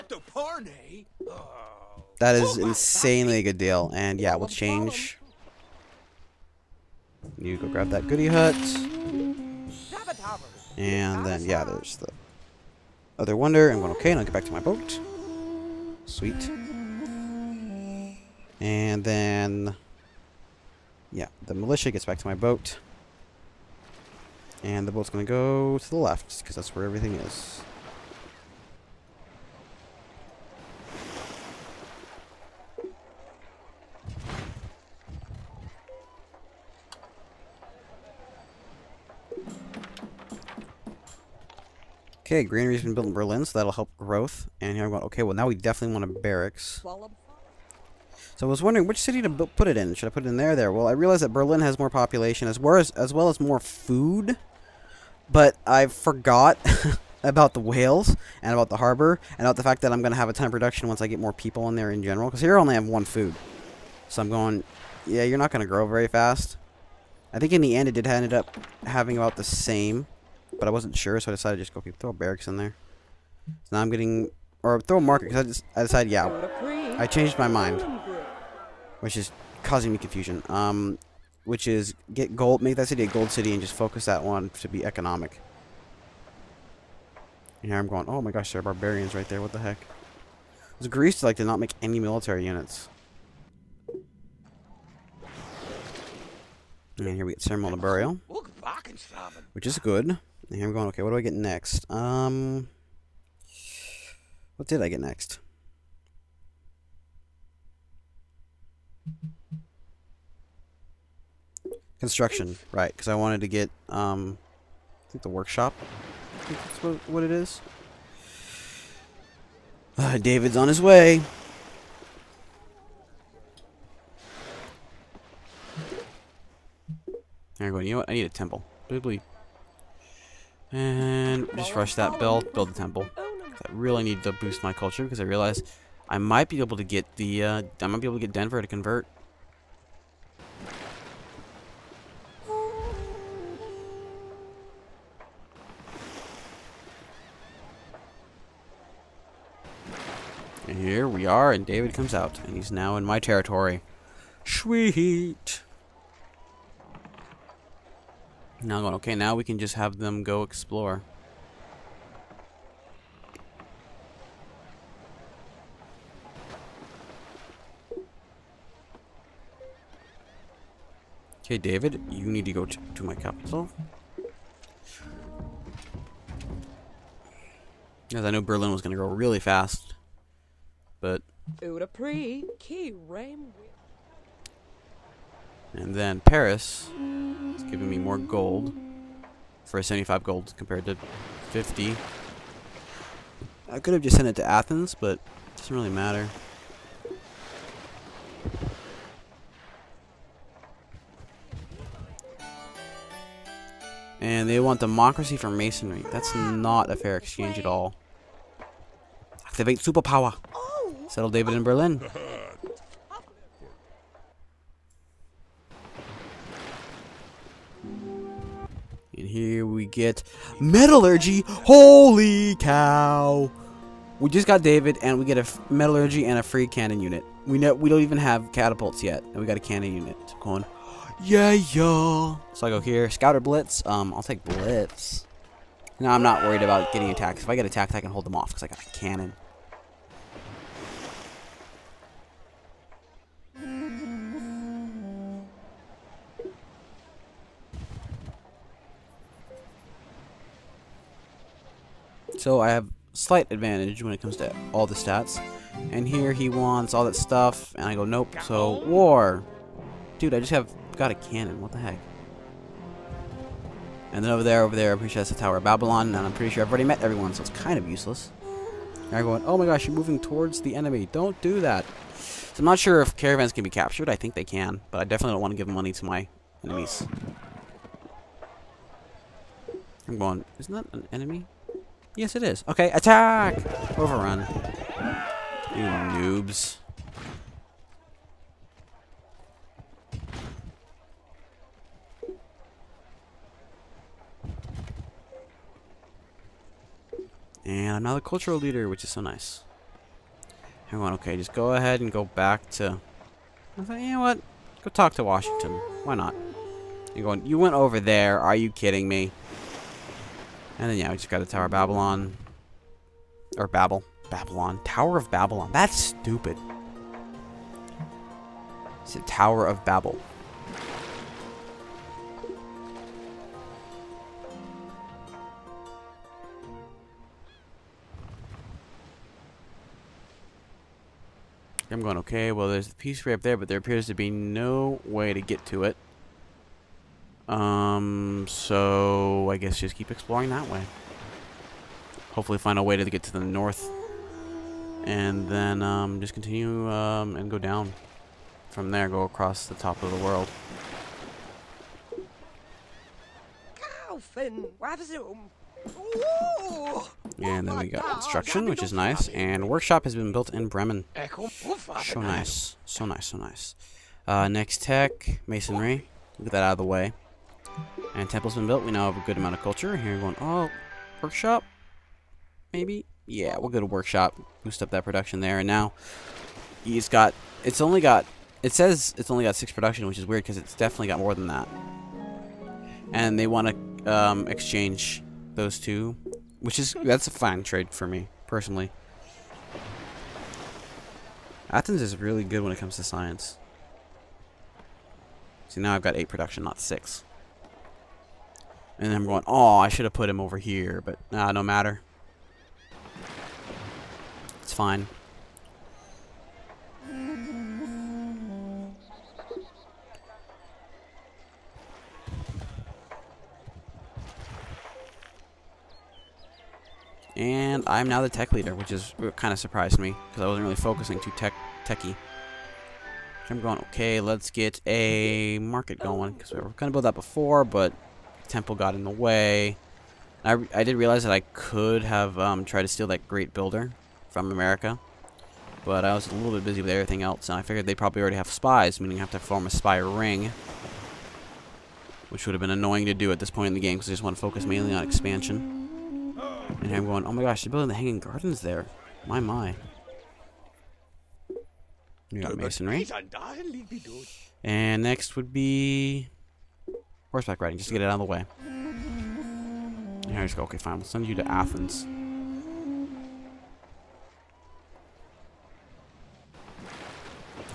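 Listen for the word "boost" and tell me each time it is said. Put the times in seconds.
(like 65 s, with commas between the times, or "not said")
134 s, 374 s.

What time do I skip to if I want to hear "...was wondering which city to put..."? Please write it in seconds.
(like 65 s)
48 s.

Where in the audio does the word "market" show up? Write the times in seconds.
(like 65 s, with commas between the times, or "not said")
75 s, 425 s.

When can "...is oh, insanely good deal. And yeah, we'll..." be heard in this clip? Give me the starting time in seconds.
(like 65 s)
2 s.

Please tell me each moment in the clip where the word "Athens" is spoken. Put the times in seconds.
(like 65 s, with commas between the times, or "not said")
194 s, 391 s, 461 s.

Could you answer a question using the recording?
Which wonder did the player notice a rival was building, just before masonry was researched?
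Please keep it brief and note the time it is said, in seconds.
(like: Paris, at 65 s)
Hanging Gardens, at 447 s.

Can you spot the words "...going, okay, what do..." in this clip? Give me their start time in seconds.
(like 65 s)
100 s.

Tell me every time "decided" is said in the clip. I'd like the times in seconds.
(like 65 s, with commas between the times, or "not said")
71 s, 75 s.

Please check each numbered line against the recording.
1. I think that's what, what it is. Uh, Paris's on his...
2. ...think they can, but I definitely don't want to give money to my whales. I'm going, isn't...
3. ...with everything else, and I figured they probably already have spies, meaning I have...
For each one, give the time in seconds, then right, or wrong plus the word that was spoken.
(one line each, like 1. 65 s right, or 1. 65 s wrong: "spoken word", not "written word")
1. 116 s wrong: "David", not "Paris"
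2. 274 s wrong: "enemies", not "whales"
3. 436 s right.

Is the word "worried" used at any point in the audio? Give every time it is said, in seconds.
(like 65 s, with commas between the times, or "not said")
236 s.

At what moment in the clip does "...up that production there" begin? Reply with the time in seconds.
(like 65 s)
374 s.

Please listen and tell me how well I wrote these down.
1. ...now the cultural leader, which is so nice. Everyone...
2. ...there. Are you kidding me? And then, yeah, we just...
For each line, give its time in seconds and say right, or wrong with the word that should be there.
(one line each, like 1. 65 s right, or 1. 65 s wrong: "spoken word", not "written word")
1. 298 s right
2. 307 s right.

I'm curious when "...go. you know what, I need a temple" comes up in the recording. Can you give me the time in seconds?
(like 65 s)
127 s.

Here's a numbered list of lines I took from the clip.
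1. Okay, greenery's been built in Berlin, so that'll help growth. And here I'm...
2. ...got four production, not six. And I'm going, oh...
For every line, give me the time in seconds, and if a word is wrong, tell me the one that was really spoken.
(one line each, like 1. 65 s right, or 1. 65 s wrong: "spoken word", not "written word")
1. 42 s right
2. 396 s wrong: "eight", not "four".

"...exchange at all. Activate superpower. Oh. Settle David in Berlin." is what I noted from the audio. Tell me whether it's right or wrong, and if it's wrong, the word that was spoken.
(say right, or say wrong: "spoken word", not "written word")
right.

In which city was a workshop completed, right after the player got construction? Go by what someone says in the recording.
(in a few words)
Bremen.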